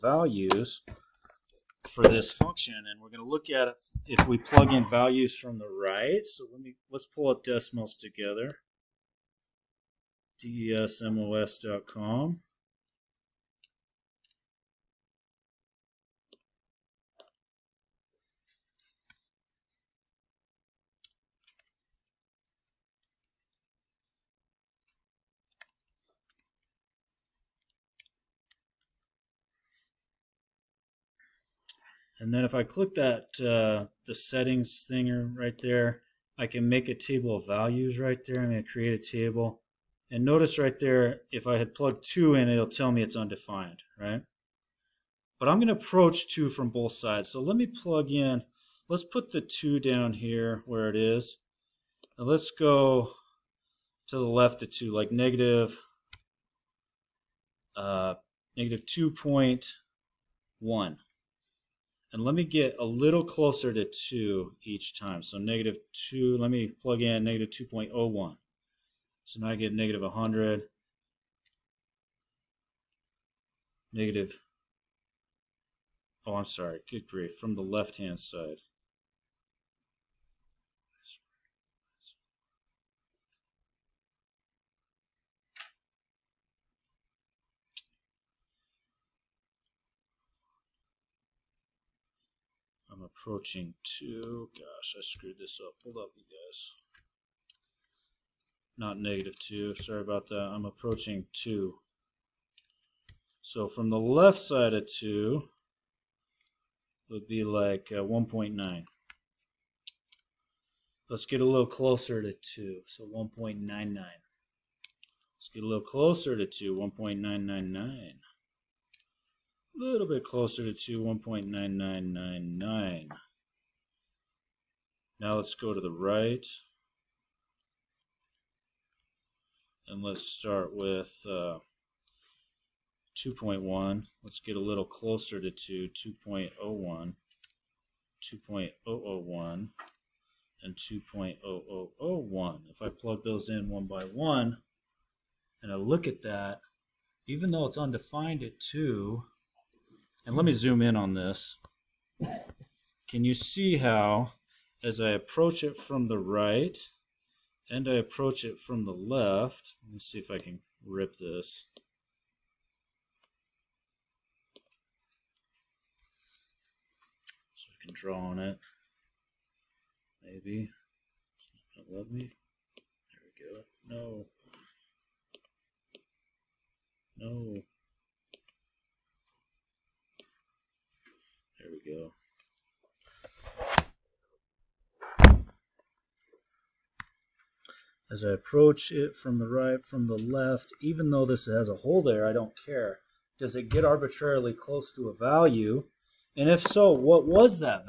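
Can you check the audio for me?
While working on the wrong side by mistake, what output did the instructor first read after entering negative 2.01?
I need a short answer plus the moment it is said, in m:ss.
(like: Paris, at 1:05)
-100, at 1:09.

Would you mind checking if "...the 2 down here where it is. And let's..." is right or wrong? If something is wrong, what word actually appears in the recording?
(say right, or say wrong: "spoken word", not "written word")
right.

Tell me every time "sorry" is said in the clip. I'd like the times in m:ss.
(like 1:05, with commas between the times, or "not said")
1:16, 1:39.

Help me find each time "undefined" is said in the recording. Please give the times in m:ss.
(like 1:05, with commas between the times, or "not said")
0:43, 2:27.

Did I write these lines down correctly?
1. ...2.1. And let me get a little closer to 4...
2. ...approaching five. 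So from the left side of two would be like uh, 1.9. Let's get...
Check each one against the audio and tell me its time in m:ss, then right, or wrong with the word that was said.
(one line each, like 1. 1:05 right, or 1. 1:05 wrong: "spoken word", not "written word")
1. 0:58 wrong: "2", not "4"
2. 1:40 wrong: "two", not "five".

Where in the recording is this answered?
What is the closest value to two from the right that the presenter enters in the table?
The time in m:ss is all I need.
2:20.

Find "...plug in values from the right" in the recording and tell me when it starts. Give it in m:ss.
0:04.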